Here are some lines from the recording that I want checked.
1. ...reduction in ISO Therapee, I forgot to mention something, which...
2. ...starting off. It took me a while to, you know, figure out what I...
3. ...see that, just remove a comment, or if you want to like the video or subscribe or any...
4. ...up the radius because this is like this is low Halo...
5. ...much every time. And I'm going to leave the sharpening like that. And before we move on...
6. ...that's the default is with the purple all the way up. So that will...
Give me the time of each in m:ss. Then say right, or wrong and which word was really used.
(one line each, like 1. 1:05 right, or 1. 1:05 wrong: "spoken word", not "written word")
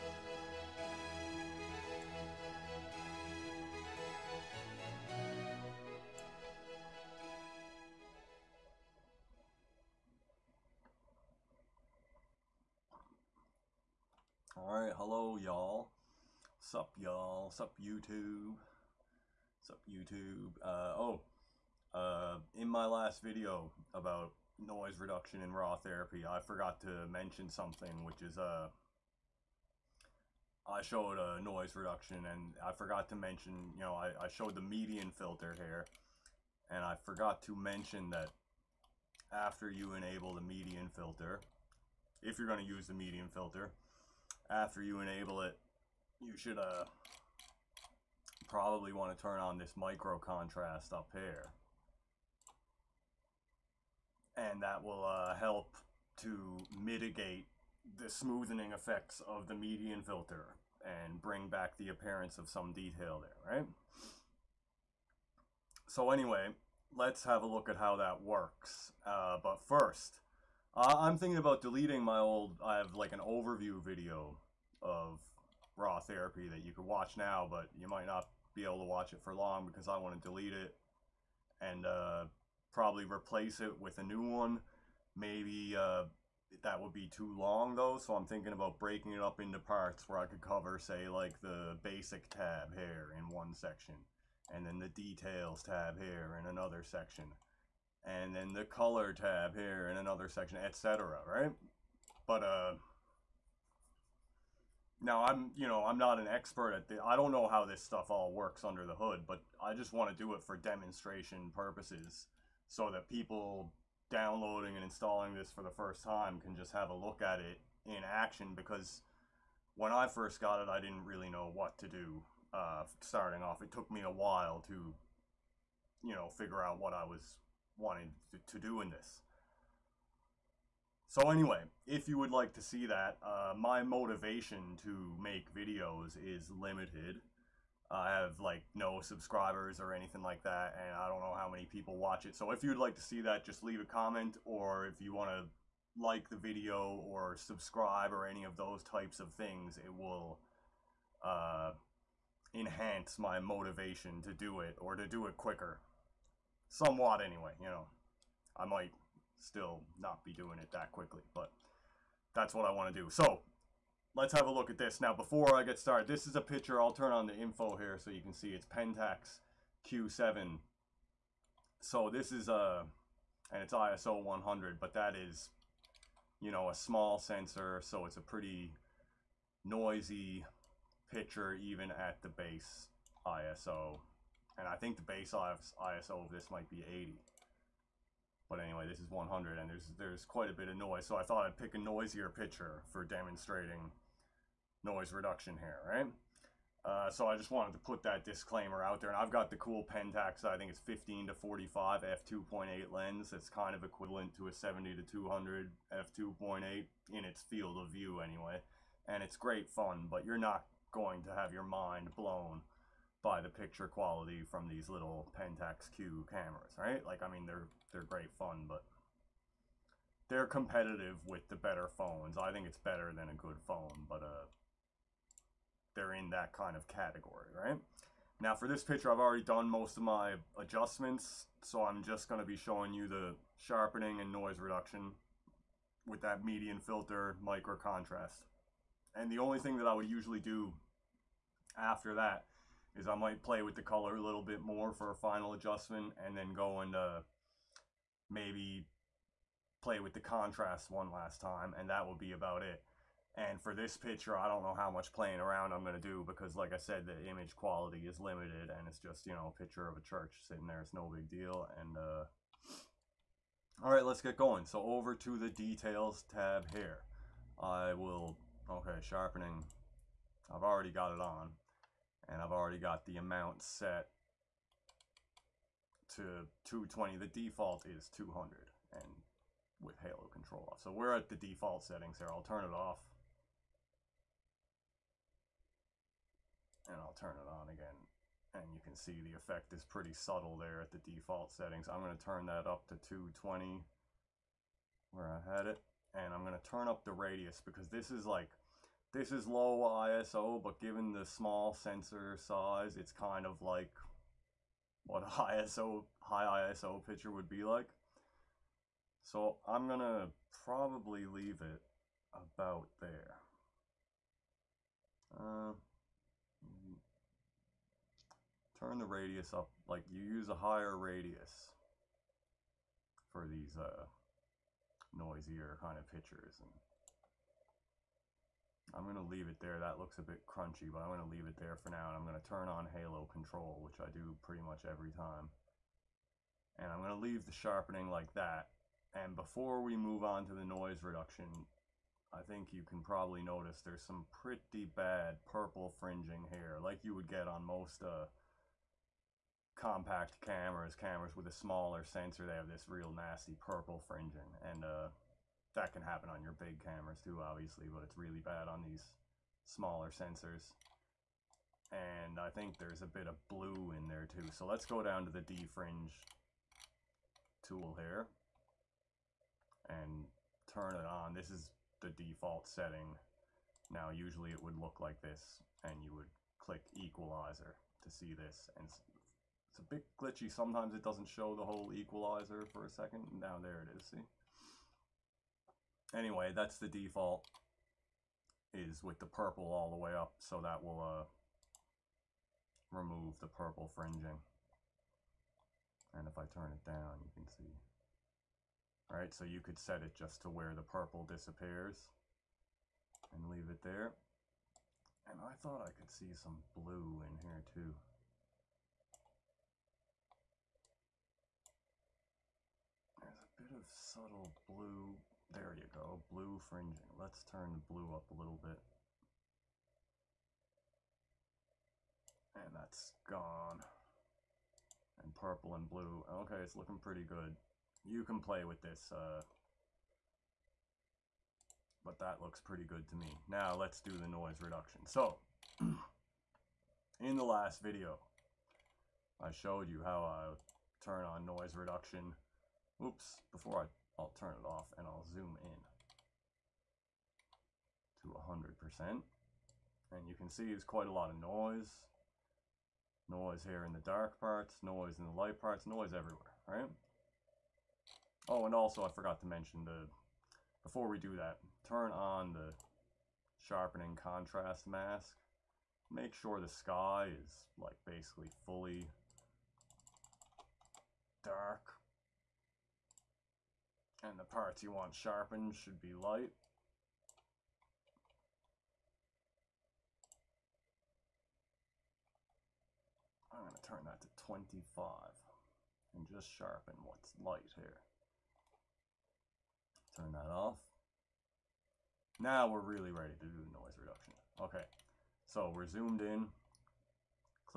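1. 0:24 wrong: "Raw", not "ISO"
2. 2:03 right
3. 2:23 wrong: "leave", not "remove"
4. 4:56 wrong: "ISO", not "Halo"
5. 5:34 right
6. 6:26 right.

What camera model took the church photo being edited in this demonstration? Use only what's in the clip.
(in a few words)
Pentax Q7.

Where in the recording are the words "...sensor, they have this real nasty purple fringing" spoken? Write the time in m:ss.
5:52.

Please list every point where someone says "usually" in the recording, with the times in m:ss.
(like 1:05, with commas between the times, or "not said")
4:00, 6:14.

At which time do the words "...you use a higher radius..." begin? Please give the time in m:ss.
5:20.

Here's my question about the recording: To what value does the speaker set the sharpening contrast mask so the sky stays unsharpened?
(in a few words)
25.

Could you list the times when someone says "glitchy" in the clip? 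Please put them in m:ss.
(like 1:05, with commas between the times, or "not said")
6:20.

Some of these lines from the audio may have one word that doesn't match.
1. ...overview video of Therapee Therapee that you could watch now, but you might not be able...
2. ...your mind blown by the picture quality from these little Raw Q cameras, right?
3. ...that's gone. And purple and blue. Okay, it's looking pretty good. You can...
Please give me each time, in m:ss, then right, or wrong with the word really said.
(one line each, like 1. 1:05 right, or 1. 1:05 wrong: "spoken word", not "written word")
1. 1:13 wrong: "Raw", not "Therapee"
2. 3:31 wrong: "Pentax", not "Raw"
3. 7:02 right.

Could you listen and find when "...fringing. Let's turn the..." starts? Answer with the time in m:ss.
6:56.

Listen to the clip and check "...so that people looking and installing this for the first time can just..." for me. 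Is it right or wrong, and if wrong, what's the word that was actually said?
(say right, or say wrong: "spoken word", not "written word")
wrong: "downloading", not "looking".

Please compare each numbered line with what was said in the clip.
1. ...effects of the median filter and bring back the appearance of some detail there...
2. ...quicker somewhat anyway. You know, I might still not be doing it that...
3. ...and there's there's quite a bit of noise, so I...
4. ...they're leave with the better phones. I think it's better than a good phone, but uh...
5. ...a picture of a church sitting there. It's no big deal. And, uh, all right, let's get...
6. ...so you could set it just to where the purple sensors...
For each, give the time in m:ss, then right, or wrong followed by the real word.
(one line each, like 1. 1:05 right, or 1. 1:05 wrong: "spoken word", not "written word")
1. 0:58 right
2. 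2:35 right
3. 3:09 right
4. 3:40 wrong: "competitive", not "leave"
5. 4:19 right
6. 6:39 wrong: "disappears", not "sensors".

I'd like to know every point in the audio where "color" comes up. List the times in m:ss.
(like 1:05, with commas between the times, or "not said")
1:38, 4:03.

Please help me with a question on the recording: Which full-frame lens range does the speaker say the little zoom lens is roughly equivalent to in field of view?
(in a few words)
70 to 200 f2.8.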